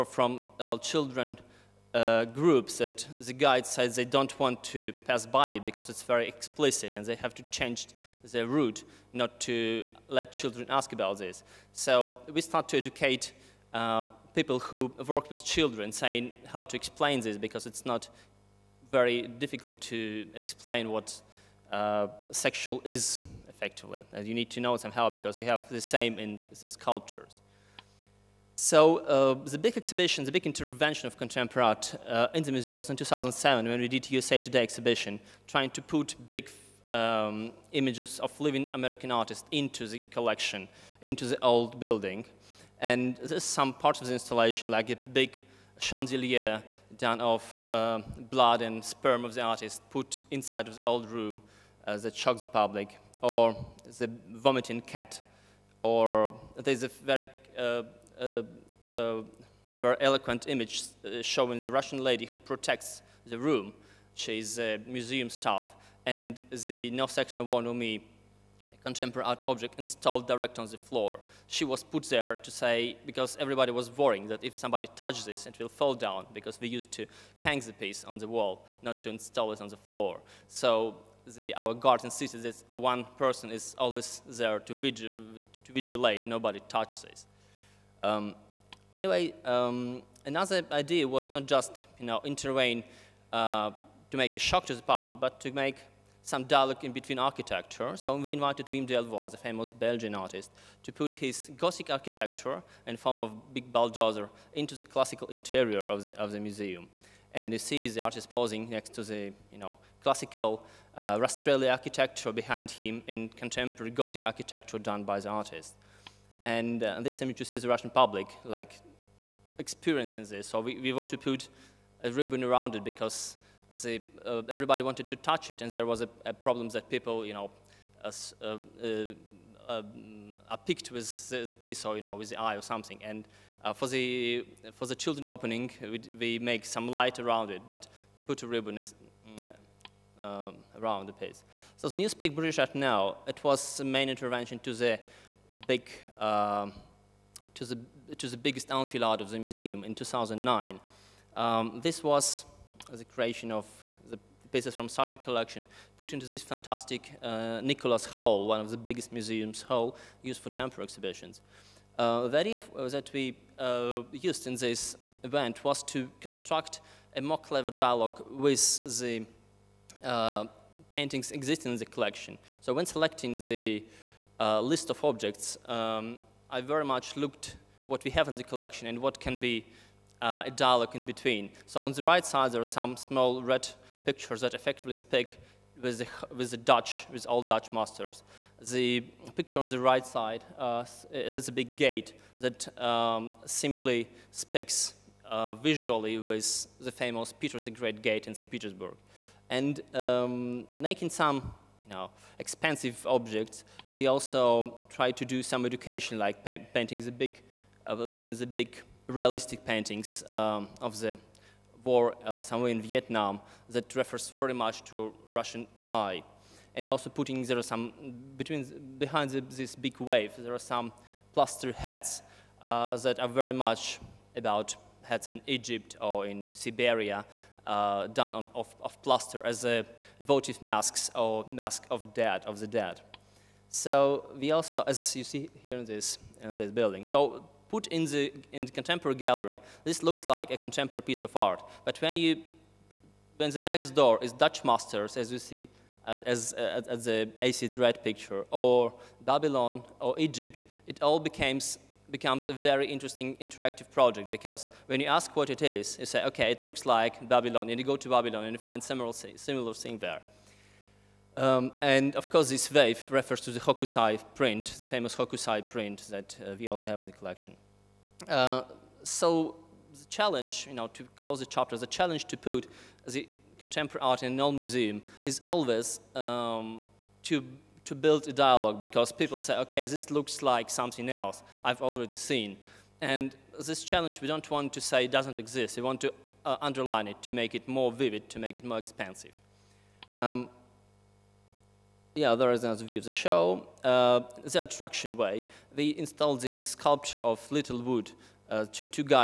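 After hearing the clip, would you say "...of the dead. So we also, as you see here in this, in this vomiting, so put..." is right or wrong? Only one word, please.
wrong.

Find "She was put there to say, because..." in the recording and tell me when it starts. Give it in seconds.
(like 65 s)
71 s.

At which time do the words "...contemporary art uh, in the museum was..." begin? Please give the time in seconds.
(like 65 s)
31 s.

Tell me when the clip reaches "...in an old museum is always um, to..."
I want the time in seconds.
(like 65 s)
274 s.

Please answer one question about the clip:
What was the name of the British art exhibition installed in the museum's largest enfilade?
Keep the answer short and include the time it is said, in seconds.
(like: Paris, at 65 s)
Newspeak, at 141 s.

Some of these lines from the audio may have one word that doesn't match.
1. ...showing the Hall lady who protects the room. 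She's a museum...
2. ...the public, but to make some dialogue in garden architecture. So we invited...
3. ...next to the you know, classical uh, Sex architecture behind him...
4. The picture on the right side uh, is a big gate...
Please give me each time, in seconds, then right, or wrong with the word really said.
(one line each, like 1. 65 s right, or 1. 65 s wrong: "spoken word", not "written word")
1. 61 s wrong: "Russian", not "Hall"
2. 94 s wrong: "between", not "garden"
3. 108 s wrong: "Rastrelli", not "Sex"
4. 188 s right.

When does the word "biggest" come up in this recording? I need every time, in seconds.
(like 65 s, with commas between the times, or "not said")
148 s, 158 s.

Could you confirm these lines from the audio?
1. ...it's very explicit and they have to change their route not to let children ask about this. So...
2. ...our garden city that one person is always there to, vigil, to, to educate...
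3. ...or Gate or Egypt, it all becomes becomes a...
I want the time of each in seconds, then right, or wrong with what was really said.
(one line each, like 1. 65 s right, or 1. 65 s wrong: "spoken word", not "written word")
1. 5 s right
2. 81 s wrong: "vigilate", not "educate"
3. 248 s wrong: "Babylon", not "Gate".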